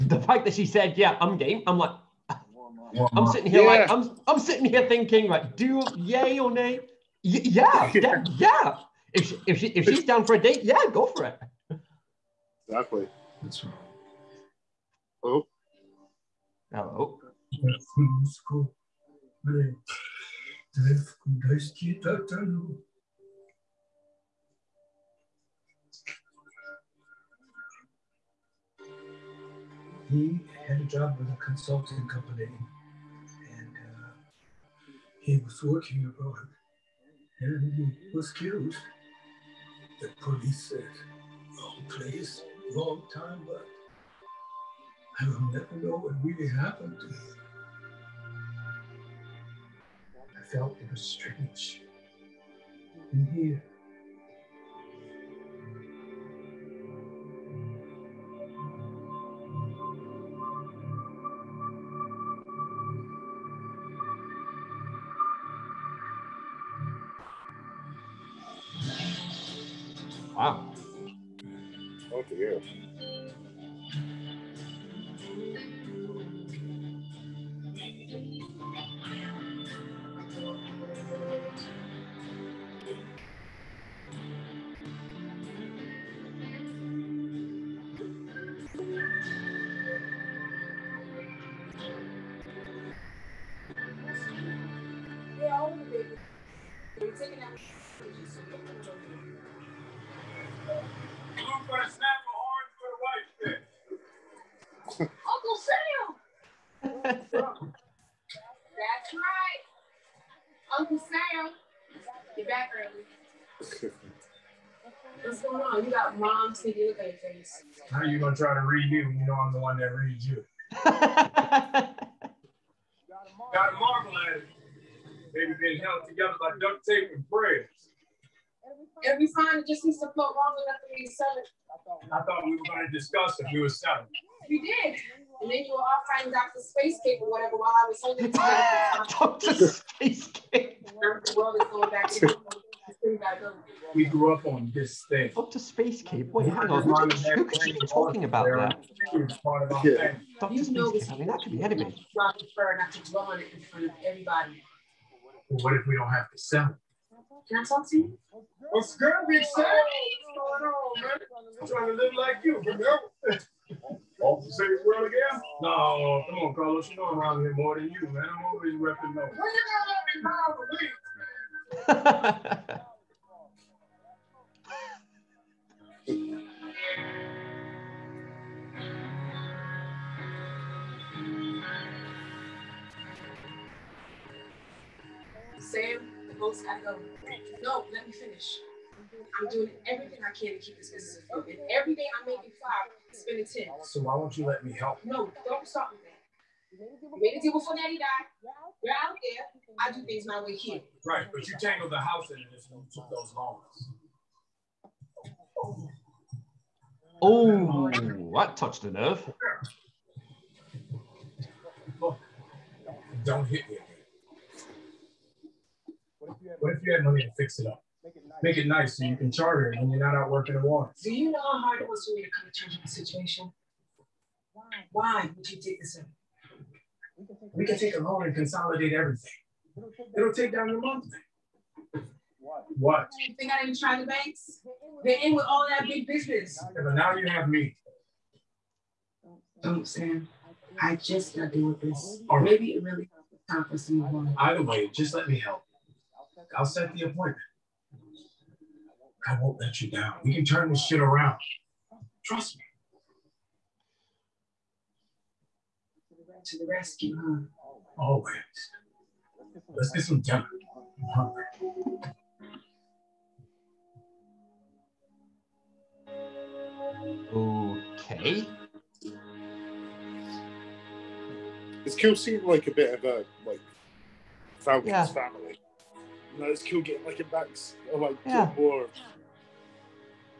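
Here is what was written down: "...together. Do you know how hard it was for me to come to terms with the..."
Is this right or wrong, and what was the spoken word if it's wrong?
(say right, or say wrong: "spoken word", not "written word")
wrong: "water", not "together".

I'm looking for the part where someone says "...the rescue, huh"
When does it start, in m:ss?
4:16.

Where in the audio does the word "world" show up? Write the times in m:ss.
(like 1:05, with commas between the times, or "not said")
2:21, 2:44.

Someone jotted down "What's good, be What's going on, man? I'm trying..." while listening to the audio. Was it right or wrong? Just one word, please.
right.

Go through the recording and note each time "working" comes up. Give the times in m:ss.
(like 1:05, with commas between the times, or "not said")
0:35, 3:40.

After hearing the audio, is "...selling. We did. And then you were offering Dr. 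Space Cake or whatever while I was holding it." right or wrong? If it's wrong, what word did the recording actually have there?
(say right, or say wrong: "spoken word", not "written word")
right.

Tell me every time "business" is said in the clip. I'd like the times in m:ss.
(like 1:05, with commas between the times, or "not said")
3:10, 3:56.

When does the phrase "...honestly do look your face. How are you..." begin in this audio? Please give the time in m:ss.
1:56.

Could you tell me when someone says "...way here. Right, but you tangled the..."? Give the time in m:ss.
3:20.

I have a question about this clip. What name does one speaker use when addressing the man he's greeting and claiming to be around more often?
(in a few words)
Carlos.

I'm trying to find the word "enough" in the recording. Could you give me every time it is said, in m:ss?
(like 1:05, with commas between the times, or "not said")
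2:10.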